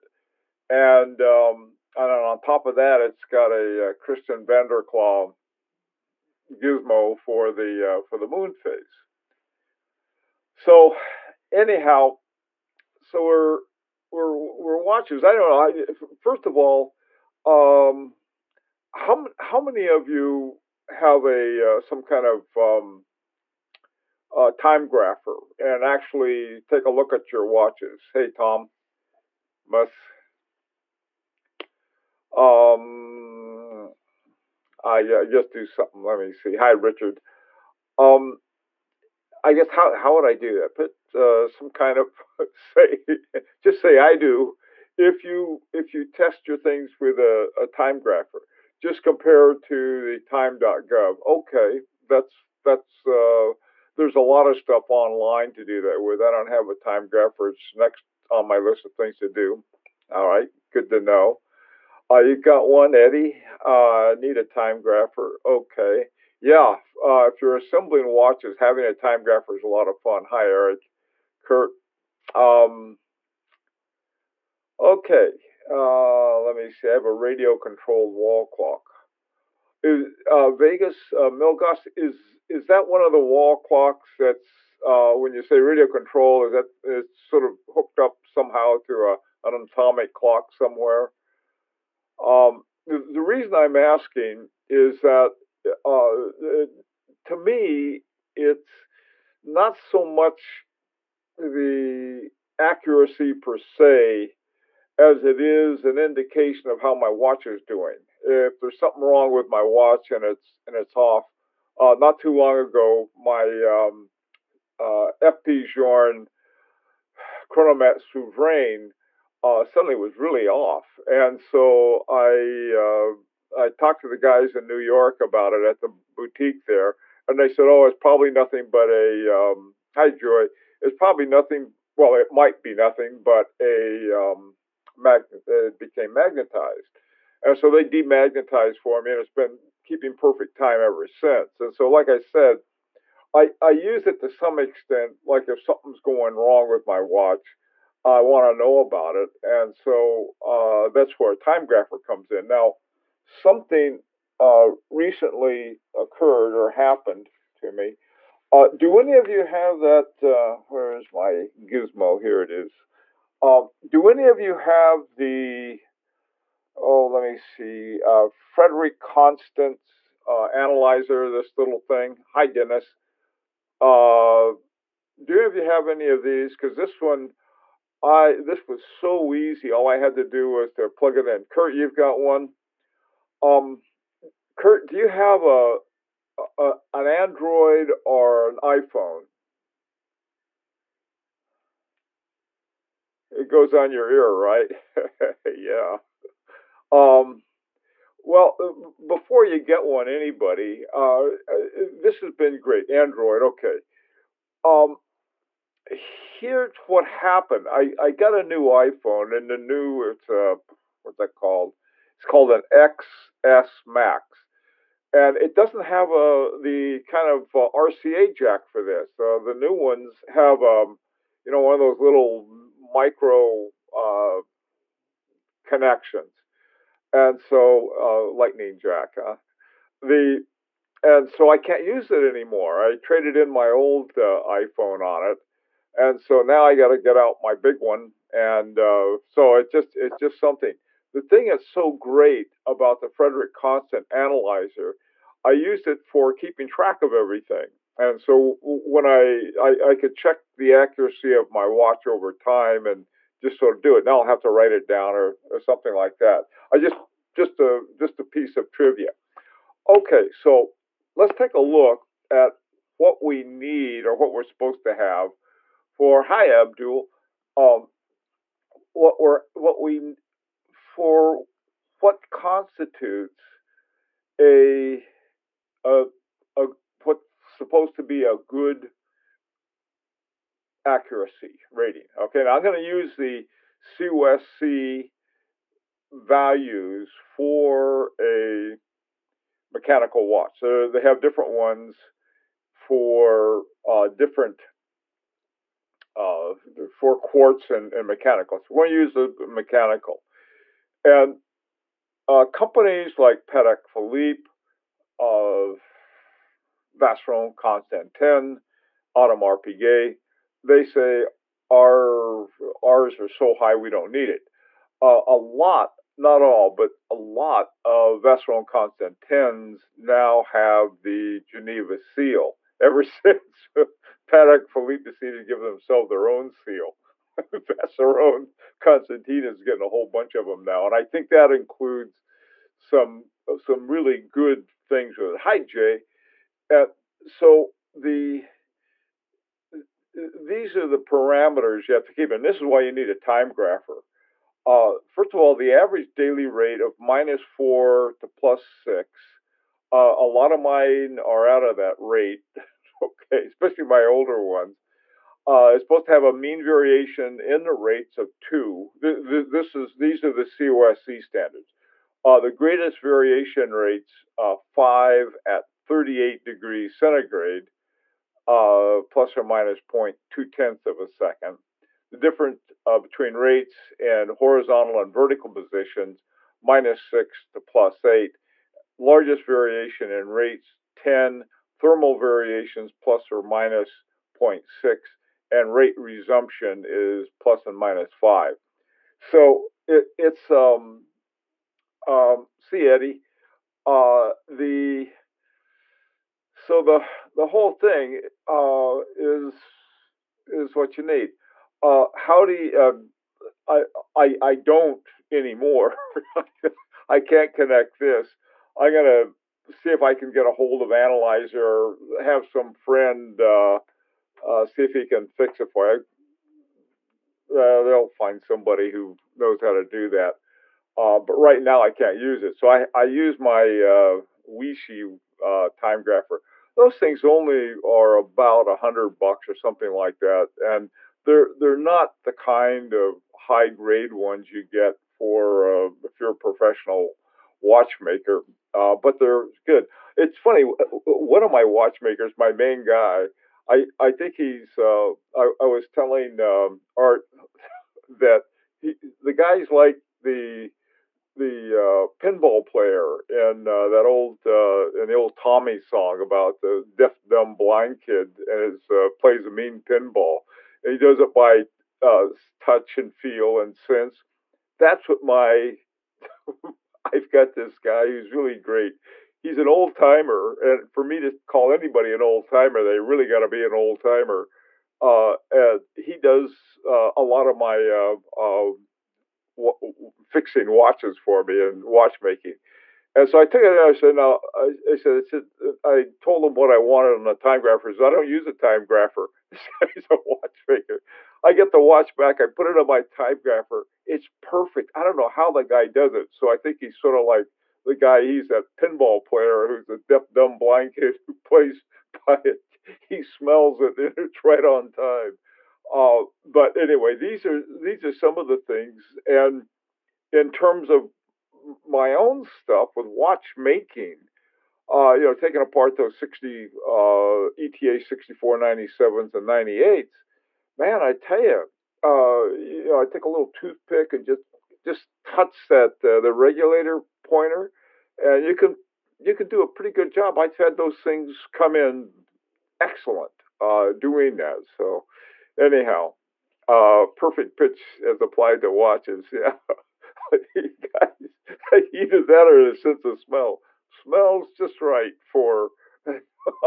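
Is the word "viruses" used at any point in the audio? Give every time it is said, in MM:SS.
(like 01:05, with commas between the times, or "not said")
not said.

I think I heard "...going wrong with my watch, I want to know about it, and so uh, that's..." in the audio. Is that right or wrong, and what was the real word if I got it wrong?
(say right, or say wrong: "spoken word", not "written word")
right.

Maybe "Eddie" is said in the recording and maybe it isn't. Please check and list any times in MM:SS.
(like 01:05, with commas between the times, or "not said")
01:02, 06:32.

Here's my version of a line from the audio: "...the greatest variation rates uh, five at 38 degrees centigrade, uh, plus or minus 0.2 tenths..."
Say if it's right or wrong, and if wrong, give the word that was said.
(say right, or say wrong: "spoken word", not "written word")
right.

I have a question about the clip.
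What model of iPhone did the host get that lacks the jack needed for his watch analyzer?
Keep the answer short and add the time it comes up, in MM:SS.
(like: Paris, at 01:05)
XS Max, at 03:32.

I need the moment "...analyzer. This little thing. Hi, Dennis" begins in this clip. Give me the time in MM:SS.
02:50.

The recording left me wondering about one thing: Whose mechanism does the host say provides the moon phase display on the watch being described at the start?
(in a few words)
Christiaan van der Klaauw.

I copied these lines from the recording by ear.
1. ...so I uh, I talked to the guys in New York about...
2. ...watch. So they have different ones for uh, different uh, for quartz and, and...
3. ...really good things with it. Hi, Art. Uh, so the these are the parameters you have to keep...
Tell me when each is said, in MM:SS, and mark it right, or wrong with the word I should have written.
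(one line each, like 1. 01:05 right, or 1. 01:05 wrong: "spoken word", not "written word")
1. 02:01 right
2. 04:50 right
3. 05:33 wrong: "Jay", not "Art".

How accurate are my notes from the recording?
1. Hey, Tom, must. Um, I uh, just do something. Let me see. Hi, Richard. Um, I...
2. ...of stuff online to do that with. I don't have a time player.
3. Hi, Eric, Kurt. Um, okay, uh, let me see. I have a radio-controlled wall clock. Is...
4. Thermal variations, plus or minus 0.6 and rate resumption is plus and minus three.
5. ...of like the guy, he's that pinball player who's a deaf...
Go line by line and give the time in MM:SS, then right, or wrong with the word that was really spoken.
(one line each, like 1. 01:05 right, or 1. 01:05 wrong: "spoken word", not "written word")
1. 00:28 right
2. 00:54 wrong: "grapher", not "player"
3. 01:10 right
4. 06:21 wrong: "five", not "three"
5. 08:17 right.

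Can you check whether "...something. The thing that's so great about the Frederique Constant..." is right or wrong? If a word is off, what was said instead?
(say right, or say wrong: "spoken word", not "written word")
right.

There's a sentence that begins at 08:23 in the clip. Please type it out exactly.
He smells it and it's right on time.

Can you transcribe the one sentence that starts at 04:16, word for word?
I just just a just a piece of trivia.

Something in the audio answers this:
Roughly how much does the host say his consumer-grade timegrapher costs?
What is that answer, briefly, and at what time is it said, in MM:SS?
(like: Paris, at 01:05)
About $100, at 07:08.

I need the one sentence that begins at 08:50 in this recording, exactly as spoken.
I've had those things come in excellent uh, doing that.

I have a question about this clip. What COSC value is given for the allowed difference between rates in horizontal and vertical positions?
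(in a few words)
-6 to +8.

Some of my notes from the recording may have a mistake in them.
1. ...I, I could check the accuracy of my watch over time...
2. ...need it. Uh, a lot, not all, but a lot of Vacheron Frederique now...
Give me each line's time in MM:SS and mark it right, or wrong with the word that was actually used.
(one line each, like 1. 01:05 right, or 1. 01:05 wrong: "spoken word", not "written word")
1. 04:09 right
2. 05:14 wrong: "Constantins", not "Frederique".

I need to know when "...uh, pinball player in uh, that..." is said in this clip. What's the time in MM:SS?
07:31.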